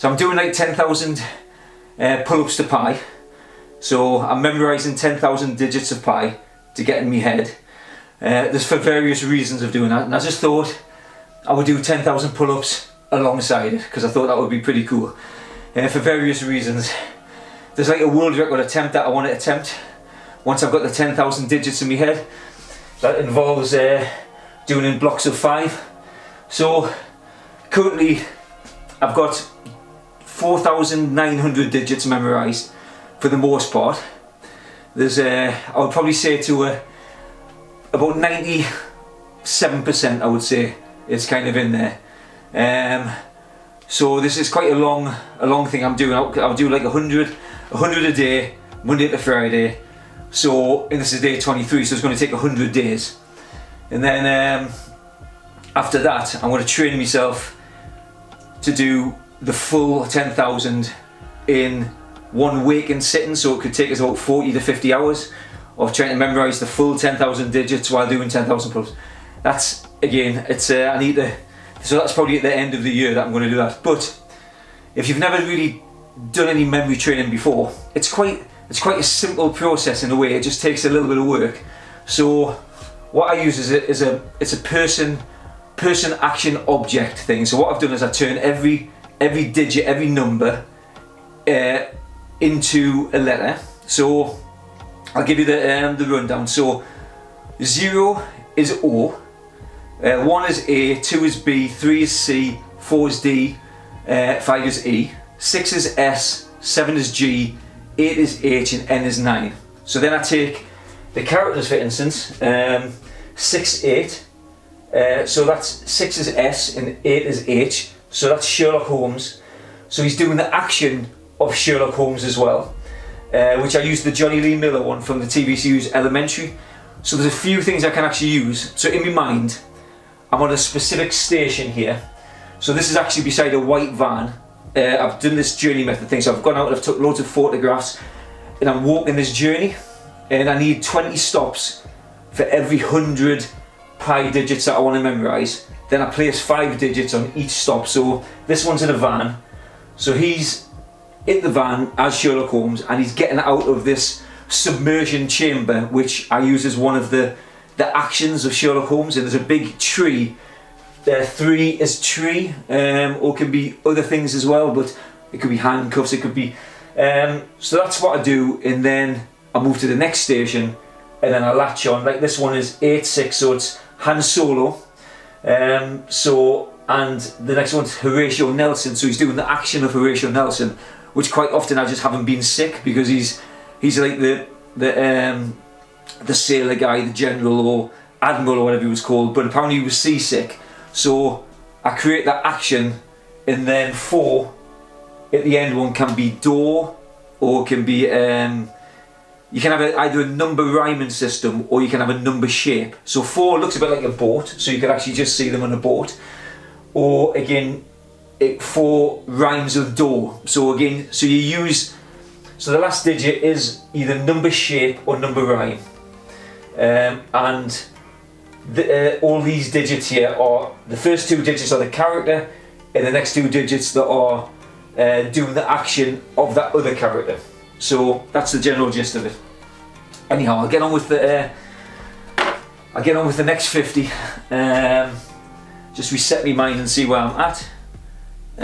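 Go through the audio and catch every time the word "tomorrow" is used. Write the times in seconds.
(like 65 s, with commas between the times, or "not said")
not said.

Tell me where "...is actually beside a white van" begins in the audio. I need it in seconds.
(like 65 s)
132 s.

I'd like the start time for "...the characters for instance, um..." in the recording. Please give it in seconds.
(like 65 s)
111 s.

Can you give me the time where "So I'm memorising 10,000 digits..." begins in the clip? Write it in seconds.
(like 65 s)
3 s.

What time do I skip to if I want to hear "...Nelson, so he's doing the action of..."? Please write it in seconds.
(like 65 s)
178 s.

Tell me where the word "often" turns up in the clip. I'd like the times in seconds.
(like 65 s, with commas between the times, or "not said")
181 s.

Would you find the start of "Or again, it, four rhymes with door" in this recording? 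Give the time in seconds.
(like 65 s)
206 s.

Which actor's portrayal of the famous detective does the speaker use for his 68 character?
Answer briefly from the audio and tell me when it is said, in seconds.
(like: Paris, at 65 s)
Jonny Lee Miller, at 124 s.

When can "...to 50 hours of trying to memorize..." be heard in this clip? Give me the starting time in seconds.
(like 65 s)
64 s.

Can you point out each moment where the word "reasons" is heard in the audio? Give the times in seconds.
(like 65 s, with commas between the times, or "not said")
9 s, 16 s.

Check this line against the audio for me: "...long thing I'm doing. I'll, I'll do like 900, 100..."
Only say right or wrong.
wrong.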